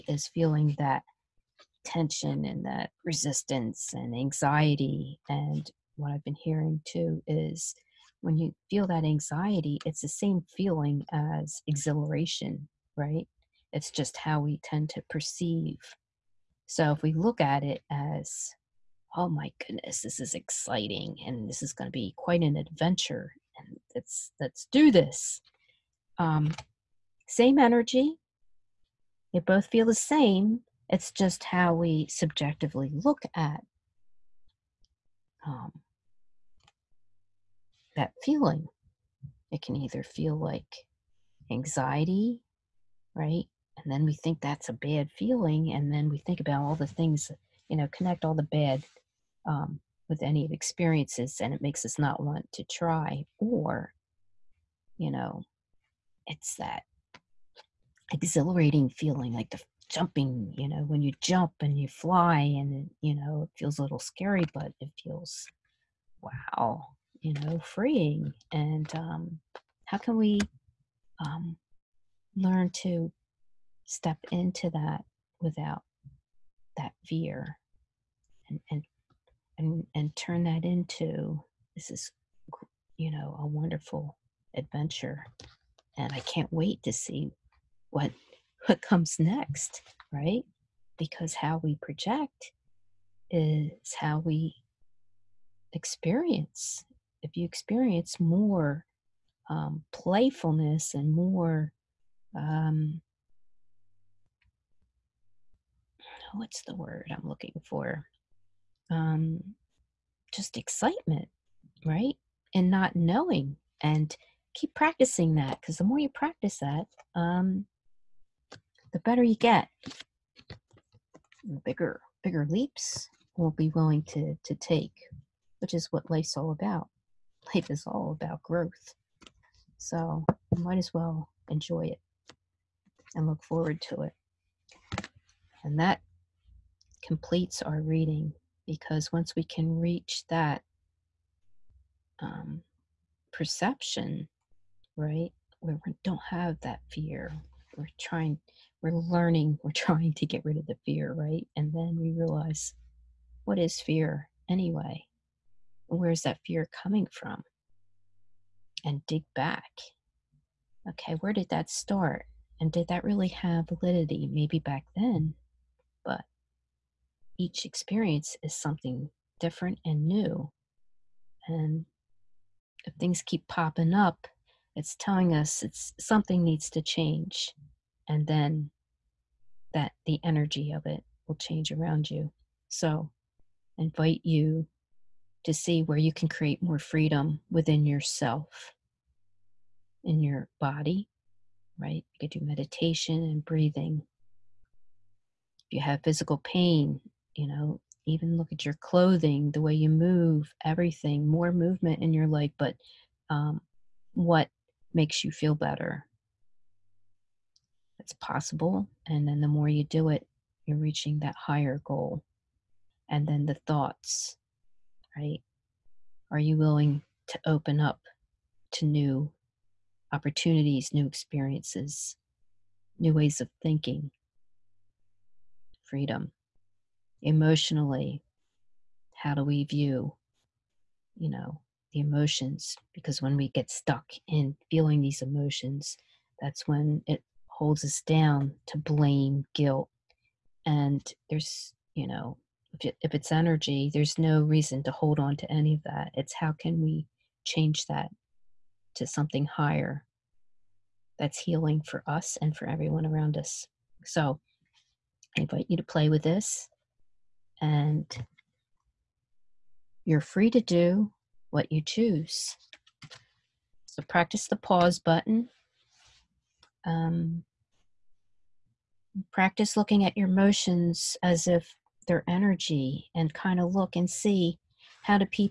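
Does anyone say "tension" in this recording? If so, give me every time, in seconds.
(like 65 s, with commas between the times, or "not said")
1 s.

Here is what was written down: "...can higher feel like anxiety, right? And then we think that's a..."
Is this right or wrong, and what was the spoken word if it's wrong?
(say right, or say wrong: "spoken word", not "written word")
wrong: "either", not "higher".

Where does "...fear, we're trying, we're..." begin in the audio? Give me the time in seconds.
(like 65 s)
146 s.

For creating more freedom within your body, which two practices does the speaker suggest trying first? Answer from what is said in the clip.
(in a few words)
meditation and breathing.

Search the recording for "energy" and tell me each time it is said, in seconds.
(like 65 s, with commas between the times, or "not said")
27 s, 180 s, 243 s, 272 s.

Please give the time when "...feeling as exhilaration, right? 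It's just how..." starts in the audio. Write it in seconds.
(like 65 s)
10 s.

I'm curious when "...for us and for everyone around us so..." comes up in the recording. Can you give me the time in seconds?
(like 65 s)
251 s.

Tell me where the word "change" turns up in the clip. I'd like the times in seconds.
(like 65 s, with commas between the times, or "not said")
176 s, 181 s, 247 s.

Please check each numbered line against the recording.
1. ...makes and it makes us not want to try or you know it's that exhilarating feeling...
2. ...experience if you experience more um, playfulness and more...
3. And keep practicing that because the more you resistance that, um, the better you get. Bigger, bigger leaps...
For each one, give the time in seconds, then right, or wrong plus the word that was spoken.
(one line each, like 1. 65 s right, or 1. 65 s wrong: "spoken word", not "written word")
1. 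50 s wrong: "experiences", not "makes"
2. 95 s right
3. 113 s wrong: "practice", not "resistance".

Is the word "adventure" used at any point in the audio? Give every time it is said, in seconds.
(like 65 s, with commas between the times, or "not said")
22 s, 84 s.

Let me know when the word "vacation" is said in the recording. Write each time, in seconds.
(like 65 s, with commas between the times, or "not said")
not said.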